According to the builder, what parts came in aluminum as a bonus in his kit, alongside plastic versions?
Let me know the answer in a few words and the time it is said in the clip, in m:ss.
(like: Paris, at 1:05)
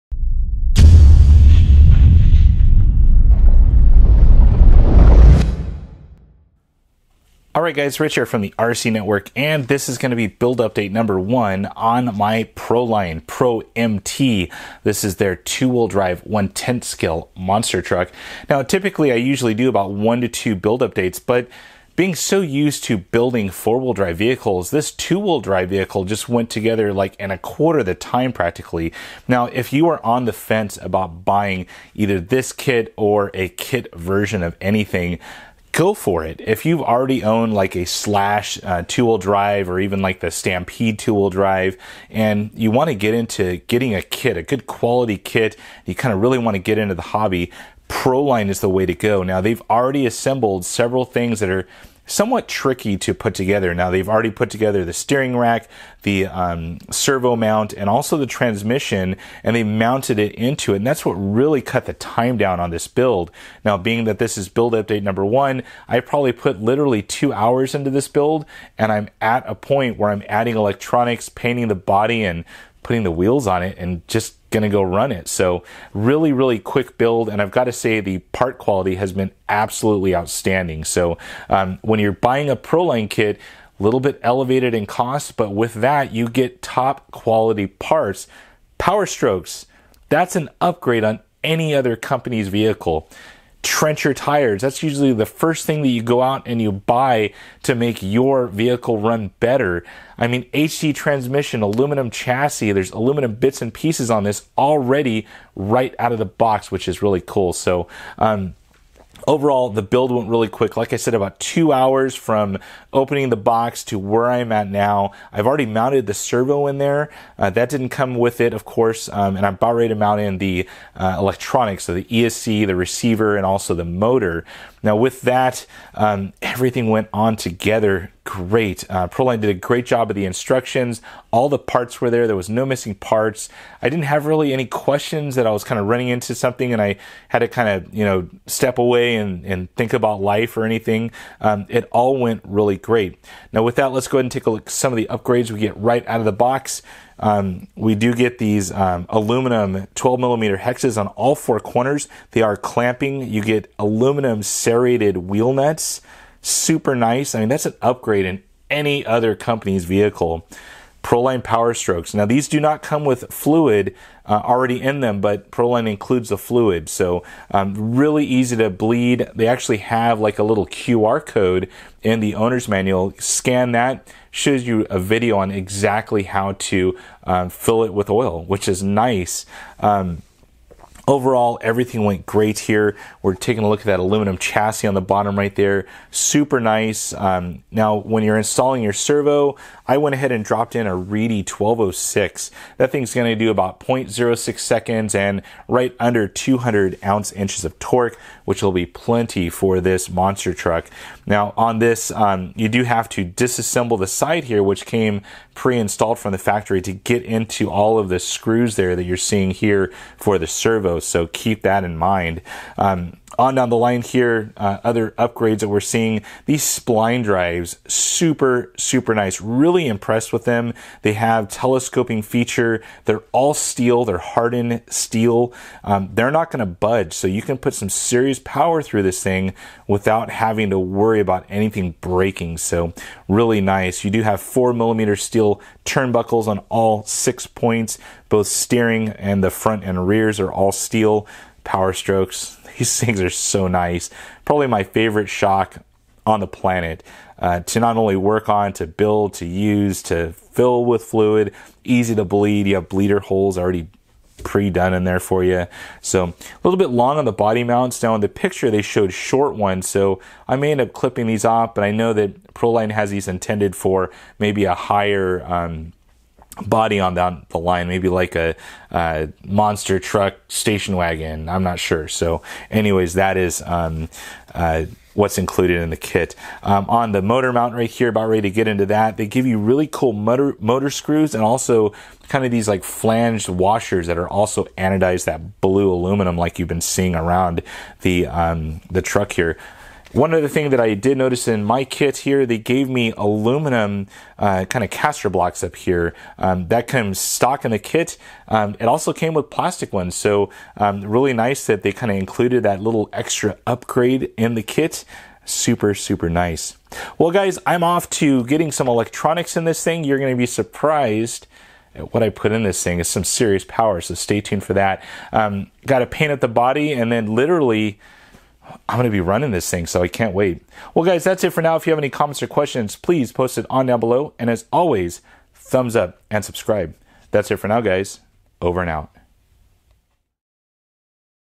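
caster blocks, at 4:54.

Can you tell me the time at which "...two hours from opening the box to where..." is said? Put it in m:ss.
1:51.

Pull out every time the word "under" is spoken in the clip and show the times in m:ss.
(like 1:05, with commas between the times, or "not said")
3:15.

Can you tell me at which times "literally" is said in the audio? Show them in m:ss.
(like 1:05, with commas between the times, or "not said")
1:06, 5:17.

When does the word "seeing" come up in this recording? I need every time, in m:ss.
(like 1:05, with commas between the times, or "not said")
3:29, 3:35, 4:46.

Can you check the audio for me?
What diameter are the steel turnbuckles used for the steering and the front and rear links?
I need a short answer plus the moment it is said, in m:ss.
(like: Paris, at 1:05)
4 millimeter, at 3:54.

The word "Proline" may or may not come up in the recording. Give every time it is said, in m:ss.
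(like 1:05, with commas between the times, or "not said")
0:12, 0:47, 1:22, 2:09, 2:41, 2:45, 4:22.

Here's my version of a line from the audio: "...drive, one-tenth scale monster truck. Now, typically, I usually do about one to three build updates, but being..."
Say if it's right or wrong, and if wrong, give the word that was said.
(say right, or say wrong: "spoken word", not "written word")
wrong: "two", not "three".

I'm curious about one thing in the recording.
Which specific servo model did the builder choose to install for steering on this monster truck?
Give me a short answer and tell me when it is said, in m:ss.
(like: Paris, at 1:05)
Reedy 1206, at 3:10.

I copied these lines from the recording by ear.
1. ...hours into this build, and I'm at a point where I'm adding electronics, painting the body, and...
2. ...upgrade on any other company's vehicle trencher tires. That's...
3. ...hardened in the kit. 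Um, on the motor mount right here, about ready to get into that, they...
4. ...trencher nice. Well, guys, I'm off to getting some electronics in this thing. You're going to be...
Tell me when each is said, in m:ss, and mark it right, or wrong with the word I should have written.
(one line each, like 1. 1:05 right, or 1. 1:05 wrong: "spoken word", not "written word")
1. 1:07 right
2. 1:30 right
3. 4:35 wrong: "included", not "hardened"
4. 5:05 wrong: "super", not "trencher".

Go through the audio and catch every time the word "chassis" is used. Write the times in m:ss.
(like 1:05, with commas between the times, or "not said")
1:42, 3:04.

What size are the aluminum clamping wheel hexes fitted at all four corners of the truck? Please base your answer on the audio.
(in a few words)
12 millimeter.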